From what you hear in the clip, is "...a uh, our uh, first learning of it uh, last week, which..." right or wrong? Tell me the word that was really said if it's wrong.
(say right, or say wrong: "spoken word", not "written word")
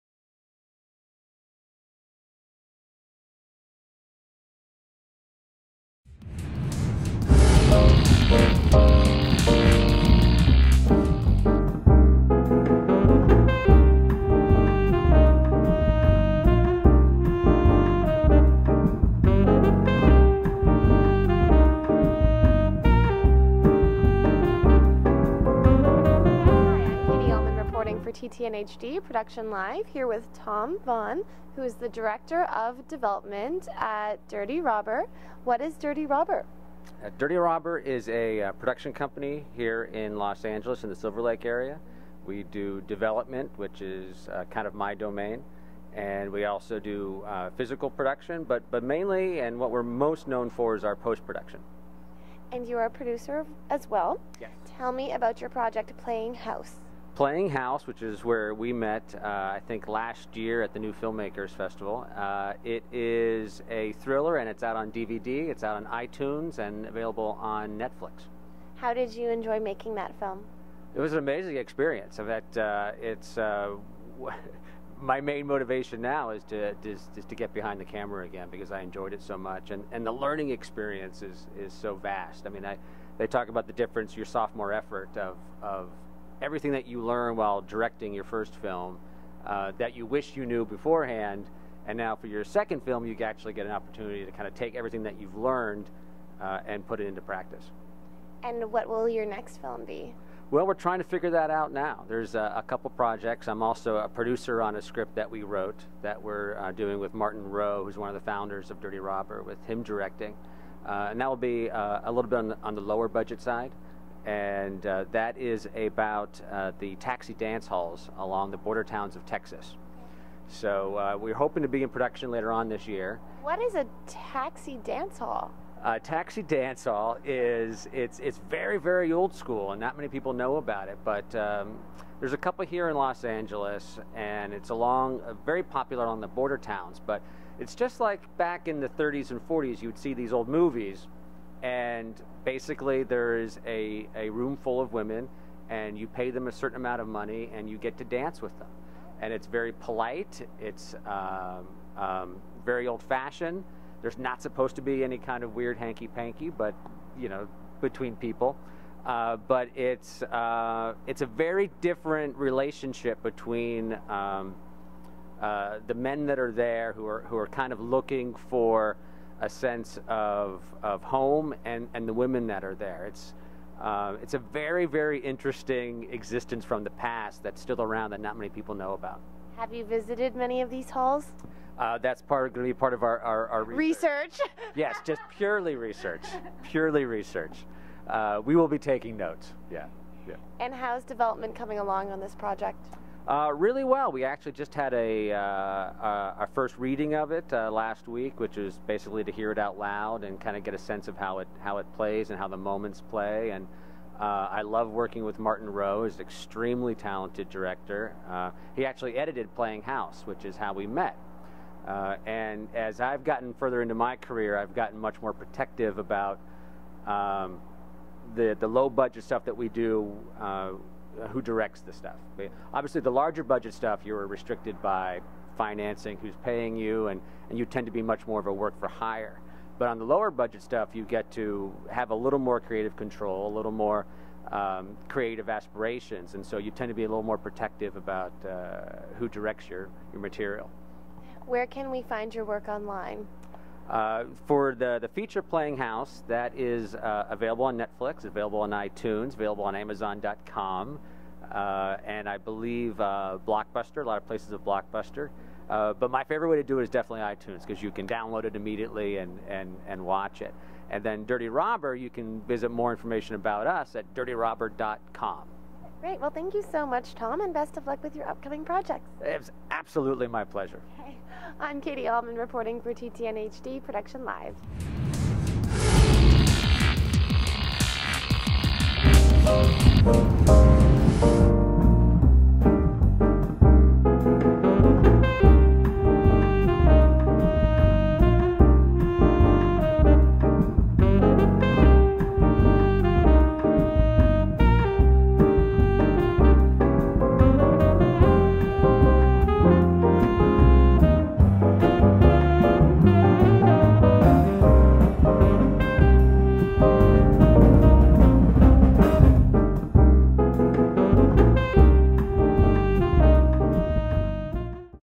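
wrong: "reading", not "learning".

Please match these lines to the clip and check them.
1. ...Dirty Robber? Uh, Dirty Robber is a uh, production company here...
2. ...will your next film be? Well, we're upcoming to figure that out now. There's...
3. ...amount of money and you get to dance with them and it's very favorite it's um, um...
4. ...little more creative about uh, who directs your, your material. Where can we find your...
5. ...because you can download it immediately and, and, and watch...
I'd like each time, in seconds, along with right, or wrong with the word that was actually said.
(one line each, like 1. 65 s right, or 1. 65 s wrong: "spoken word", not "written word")
1. 35 s right
2. 98 s wrong: "trying", not "upcoming"
3. 146 s wrong: "polite", not "favorite"
4. 237 s wrong: "protective", not "creative"
5. 257 s right.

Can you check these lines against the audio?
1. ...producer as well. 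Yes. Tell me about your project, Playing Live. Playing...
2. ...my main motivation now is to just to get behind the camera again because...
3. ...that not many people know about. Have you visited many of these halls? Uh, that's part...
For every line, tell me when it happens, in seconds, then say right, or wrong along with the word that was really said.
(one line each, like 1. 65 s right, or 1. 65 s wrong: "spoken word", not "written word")
1. 52 s wrong: "House", not "Live"
2. 74 s right
3. 178 s right.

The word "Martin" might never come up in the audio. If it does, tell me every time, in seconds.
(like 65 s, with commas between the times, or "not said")
107 s, 205 s.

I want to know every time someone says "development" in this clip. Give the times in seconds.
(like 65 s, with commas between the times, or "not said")
32 s, 42 s, 191 s.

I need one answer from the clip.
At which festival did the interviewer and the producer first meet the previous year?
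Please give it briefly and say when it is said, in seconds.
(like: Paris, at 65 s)
New Filmmakers Festival, at 60 s.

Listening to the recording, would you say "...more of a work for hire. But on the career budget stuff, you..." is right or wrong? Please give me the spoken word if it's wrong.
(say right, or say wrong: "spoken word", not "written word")
wrong: "lower", not "career".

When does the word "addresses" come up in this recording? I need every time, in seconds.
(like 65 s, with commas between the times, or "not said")
not said.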